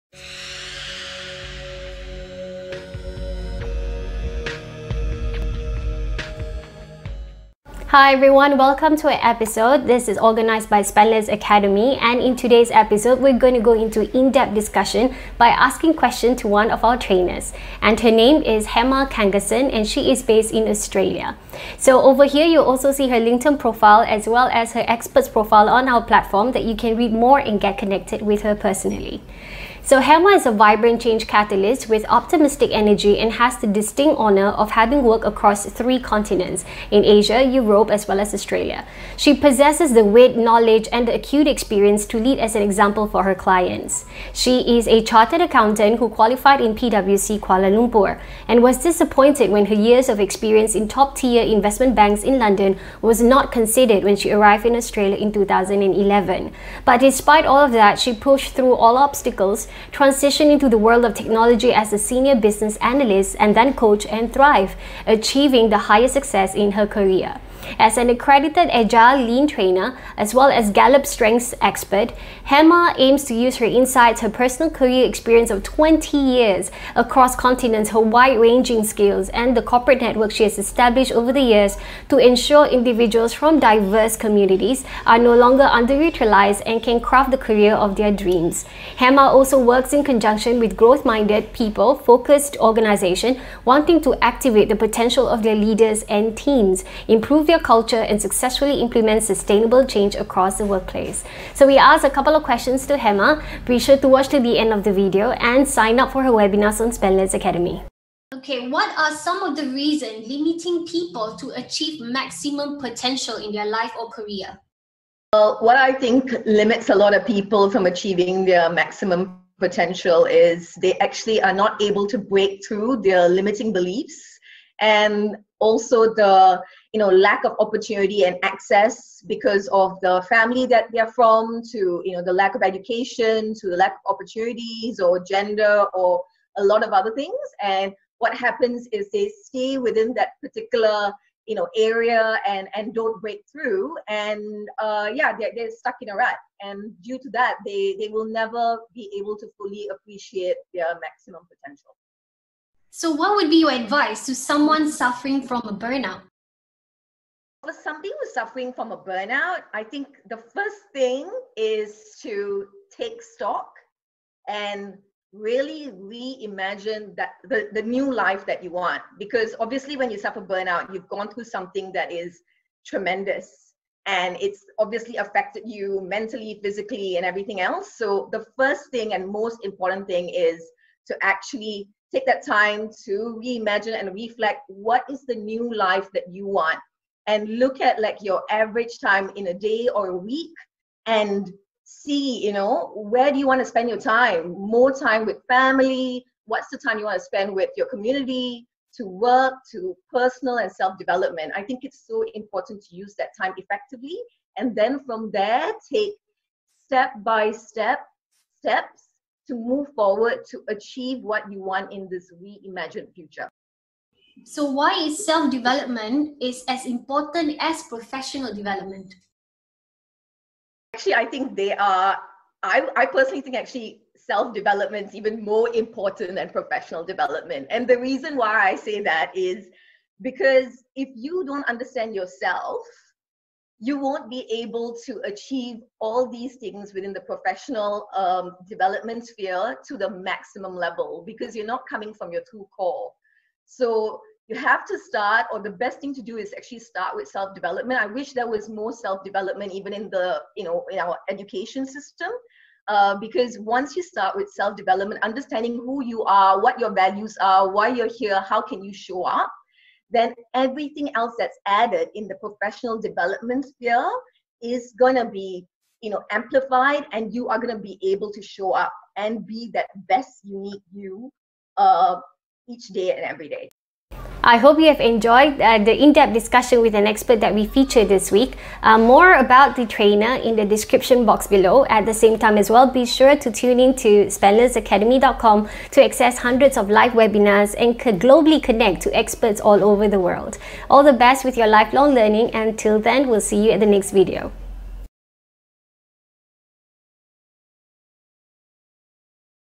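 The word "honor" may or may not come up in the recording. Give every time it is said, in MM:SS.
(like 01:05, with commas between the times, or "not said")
00:34.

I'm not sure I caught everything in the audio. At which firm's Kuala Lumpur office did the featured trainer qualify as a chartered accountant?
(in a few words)
PwC.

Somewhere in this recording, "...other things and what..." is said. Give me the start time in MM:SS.
02:16.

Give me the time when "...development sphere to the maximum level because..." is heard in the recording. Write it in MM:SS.
03:58.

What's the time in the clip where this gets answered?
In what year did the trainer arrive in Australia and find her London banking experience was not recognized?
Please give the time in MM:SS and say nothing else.
00:55.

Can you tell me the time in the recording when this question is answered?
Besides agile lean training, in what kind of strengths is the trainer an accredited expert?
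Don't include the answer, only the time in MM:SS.
01:10.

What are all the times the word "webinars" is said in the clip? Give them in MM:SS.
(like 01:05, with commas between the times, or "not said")
01:46, 04:47.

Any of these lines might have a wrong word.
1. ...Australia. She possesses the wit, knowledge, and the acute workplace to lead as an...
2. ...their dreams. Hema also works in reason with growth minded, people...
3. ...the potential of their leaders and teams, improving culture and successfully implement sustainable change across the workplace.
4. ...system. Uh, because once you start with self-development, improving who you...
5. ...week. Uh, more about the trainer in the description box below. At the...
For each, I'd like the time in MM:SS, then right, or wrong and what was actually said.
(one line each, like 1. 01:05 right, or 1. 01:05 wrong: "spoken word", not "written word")
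1. 00:38 wrong: "experience", not "workplace"
2. 01:27 wrong: "conjunction", not "reason"
3. 01:34 right
4. 04:11 wrong: "understanding", not "improving"
5. 04:38 right.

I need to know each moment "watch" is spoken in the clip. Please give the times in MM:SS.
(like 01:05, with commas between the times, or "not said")
01:44.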